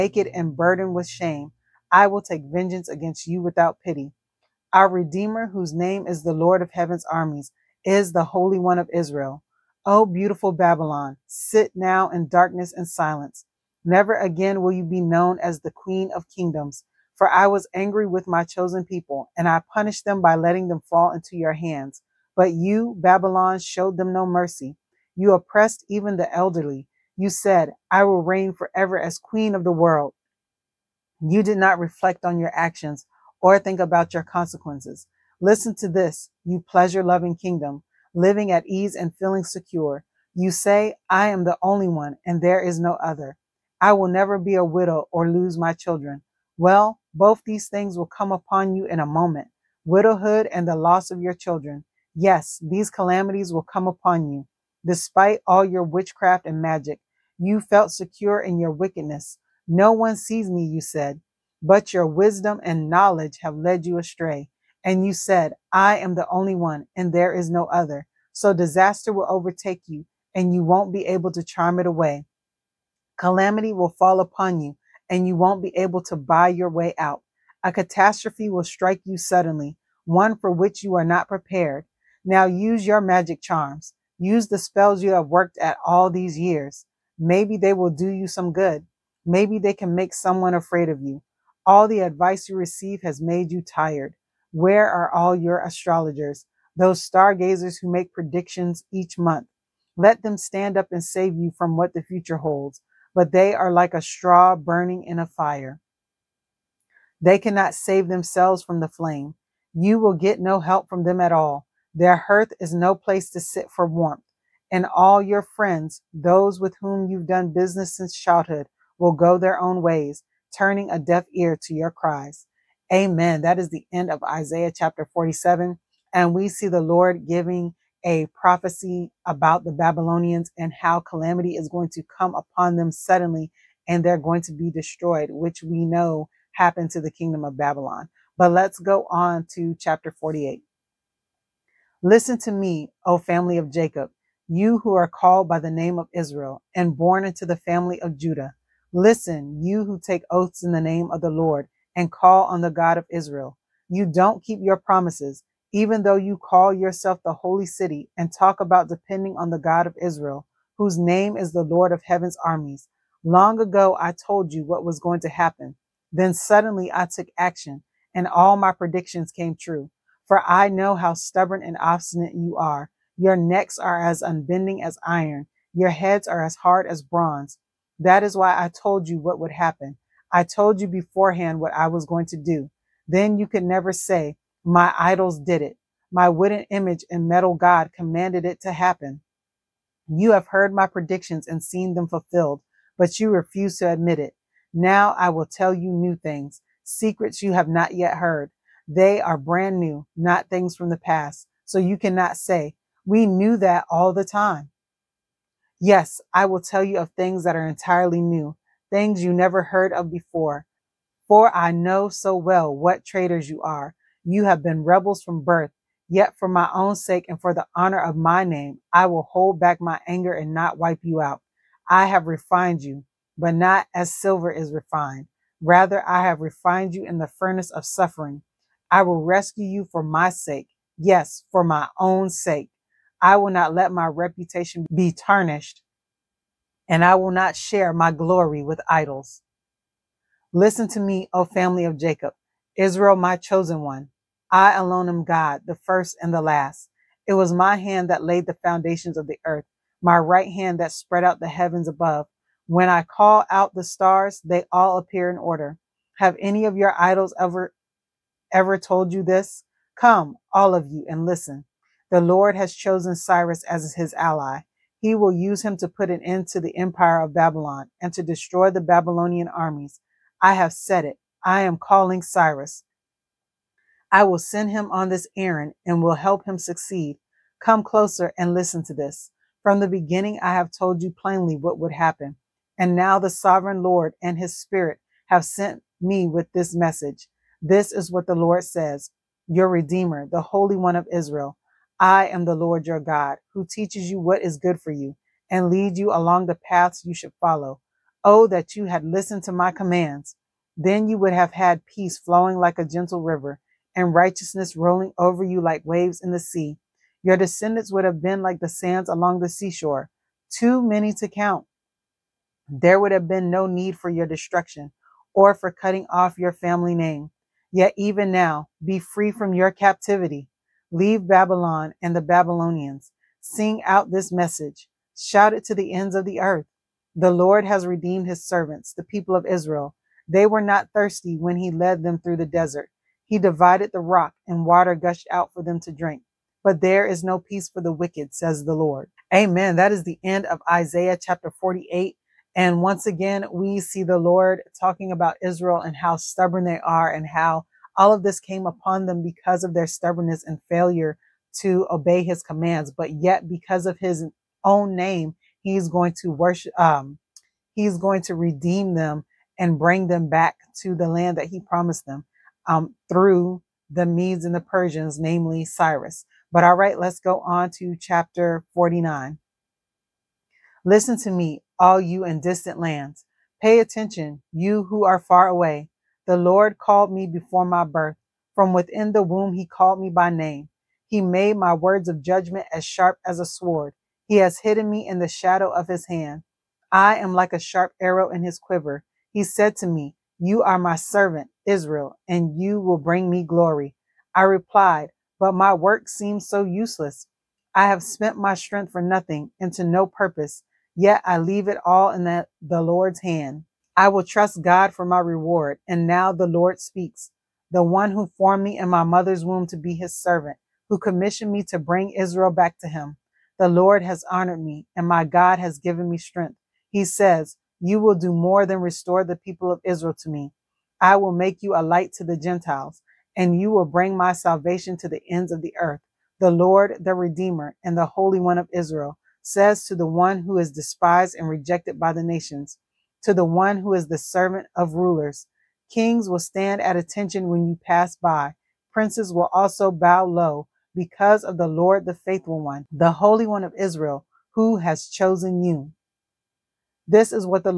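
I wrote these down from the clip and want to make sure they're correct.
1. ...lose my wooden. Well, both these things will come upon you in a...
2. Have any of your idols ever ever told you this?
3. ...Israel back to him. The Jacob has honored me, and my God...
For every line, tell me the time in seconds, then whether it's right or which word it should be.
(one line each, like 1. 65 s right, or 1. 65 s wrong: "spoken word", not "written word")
1. 45 s wrong: "children", not "wooden"
2. 256 s right
3. 412 s wrong: "Lord", not "Jacob".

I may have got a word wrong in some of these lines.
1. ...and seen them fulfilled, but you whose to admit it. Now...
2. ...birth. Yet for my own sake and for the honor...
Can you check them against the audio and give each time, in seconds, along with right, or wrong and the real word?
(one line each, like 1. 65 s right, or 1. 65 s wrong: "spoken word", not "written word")
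1. 191 s wrong: "refuse", not "whose"
2. 215 s right.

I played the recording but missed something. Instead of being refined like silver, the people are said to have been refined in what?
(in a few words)
the furnace of suffering.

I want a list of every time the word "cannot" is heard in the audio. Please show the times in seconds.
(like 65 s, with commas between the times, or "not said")
107 s, 201 s.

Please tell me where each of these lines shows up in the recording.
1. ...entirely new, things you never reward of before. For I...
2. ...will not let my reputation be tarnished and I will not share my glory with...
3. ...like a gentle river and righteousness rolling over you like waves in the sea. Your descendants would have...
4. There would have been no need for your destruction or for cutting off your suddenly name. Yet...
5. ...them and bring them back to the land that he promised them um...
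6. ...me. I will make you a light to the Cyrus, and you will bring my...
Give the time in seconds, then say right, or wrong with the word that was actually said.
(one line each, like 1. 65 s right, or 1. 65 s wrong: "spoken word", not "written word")
1. 207 s wrong: "heard", not "reward"
2. 233 s right
3. 302 s right
4. 312 s wrong: "family", not "suddenly"
5. 358 s right
6. 420 s wrong: "Gentiles", not "Cyrus".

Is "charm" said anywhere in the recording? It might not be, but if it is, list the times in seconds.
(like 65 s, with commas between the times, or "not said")
71 s, 83 s.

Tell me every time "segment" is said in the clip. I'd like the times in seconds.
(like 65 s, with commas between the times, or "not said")
not said.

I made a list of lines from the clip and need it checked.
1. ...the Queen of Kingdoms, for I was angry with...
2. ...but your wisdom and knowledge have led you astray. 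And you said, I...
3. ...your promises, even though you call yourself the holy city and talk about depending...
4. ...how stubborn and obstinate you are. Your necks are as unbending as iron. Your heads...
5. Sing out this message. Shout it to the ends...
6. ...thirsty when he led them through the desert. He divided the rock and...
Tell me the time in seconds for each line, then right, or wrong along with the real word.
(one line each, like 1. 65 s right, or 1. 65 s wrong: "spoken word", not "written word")
1. 15 s right
2. 61 s right
3. 154 s right
4. 170 s right
5. 323 s right
6. 330 s right.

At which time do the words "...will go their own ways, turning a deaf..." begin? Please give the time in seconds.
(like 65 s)
118 s.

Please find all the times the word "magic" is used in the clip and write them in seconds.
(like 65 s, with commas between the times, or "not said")
56 s, 83 s.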